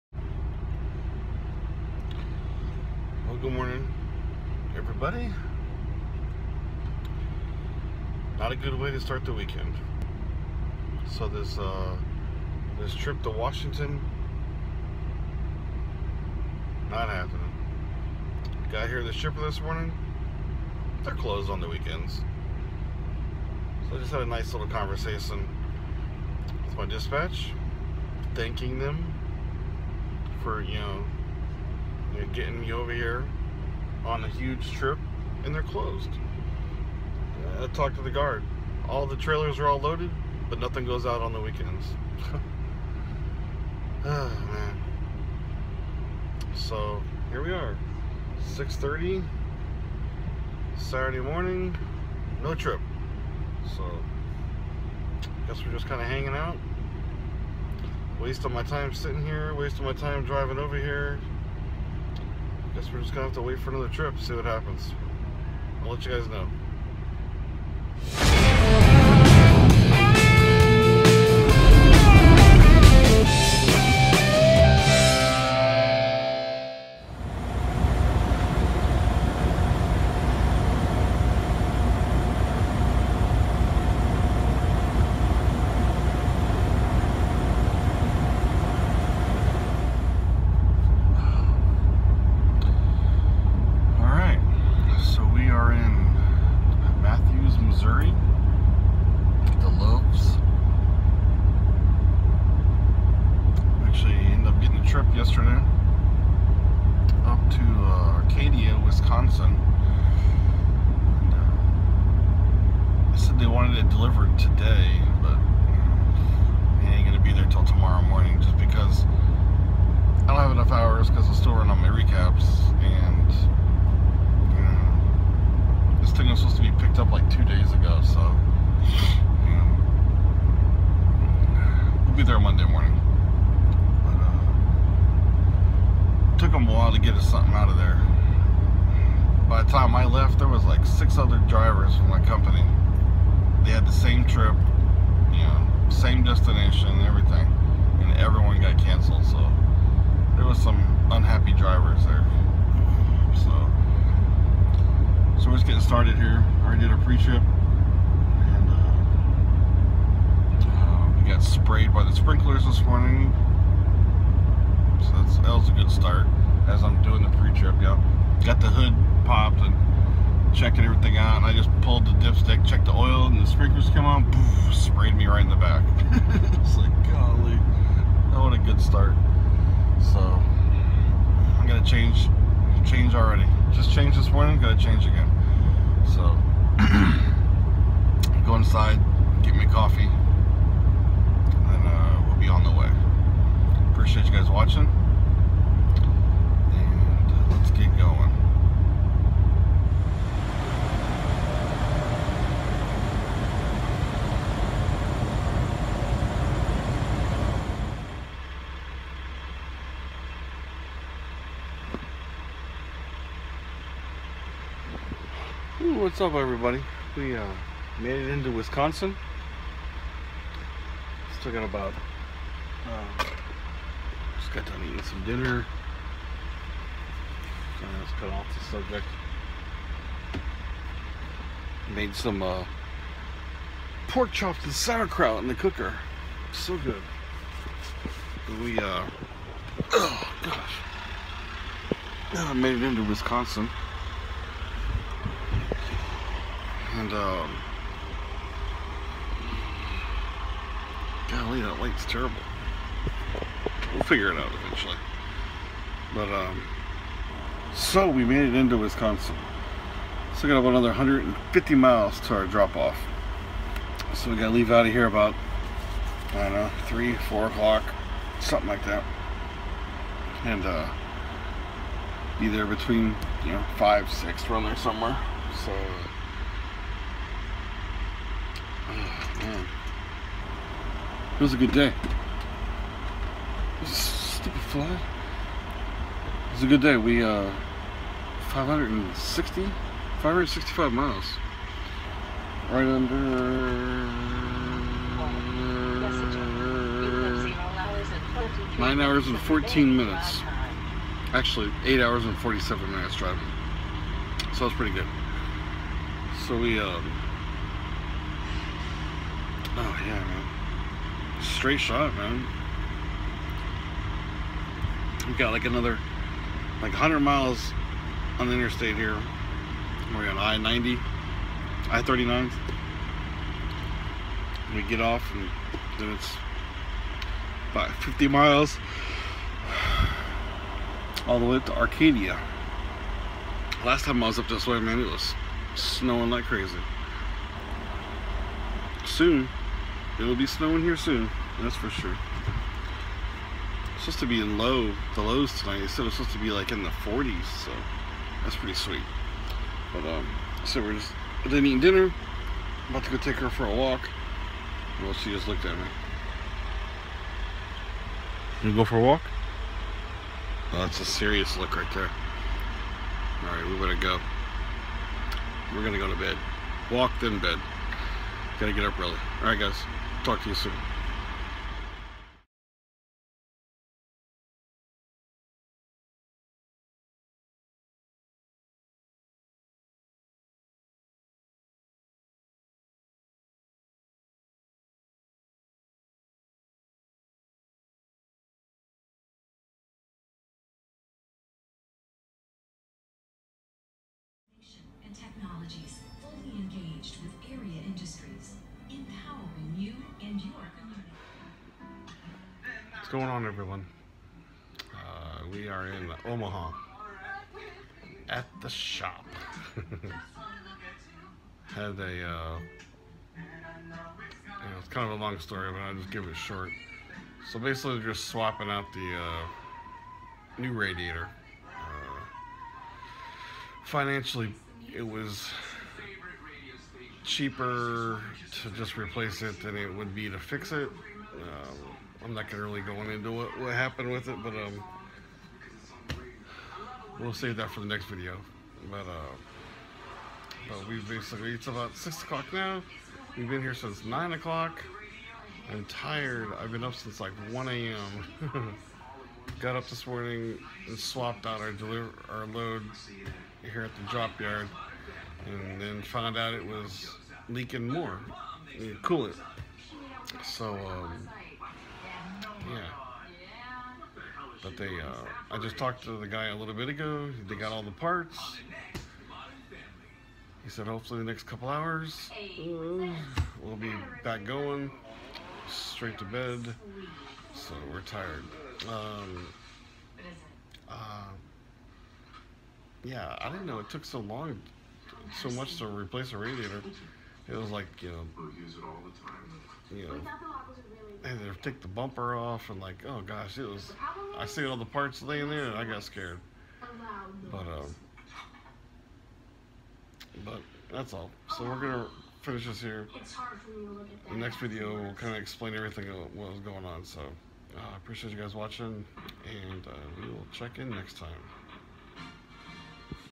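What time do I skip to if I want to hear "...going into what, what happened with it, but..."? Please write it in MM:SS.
07:12.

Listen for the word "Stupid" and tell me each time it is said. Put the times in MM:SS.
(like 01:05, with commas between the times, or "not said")
04:43.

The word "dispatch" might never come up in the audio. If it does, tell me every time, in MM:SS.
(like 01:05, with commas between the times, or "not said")
00:26.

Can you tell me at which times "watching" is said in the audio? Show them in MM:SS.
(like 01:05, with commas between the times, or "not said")
03:14, 08:28.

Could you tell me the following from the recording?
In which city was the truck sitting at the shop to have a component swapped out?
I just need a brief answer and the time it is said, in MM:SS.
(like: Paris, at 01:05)
Omaha, at 06:46.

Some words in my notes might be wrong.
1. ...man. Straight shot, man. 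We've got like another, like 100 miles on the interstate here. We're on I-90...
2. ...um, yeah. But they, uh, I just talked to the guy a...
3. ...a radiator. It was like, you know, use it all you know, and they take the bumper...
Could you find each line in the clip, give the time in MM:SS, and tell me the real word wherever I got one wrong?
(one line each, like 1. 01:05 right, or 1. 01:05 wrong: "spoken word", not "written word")
1. 05:10 right
2. 07:40 right
3. 08:06 right.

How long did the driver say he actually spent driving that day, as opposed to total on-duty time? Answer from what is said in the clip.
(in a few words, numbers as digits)
8 hours 47 minutes.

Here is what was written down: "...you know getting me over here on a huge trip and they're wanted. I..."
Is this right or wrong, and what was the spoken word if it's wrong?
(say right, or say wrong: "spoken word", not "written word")
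wrong: "closed", not "wanted".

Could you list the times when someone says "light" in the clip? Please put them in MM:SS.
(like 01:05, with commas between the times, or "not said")
04:11.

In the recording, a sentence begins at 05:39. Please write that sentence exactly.
Soon, It'll be snowing here soon, that's for sure.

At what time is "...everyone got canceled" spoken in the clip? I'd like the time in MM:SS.
02:28.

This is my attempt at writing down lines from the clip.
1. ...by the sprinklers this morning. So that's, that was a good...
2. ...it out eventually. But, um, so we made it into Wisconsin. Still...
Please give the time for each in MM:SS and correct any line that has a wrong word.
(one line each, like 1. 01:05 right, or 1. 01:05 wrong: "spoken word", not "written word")
1. 02:41 right
2. 04:14 right.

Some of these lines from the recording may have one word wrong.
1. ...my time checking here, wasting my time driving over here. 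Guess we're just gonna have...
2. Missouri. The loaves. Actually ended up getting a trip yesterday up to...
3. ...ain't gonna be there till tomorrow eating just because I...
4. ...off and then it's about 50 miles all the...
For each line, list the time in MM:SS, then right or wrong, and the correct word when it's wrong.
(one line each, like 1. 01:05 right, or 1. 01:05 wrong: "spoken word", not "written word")
1. 00:58 wrong: "sitting", not "checking"
2. 01:37 right
3. 01:56 wrong: "morning", not "eating"
4. 05:24 right.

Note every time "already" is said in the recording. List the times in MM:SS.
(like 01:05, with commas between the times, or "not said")
02:36, 03:03.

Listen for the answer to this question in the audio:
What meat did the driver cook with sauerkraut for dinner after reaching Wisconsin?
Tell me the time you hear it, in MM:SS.
03:54.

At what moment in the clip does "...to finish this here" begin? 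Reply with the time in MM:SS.
08:21.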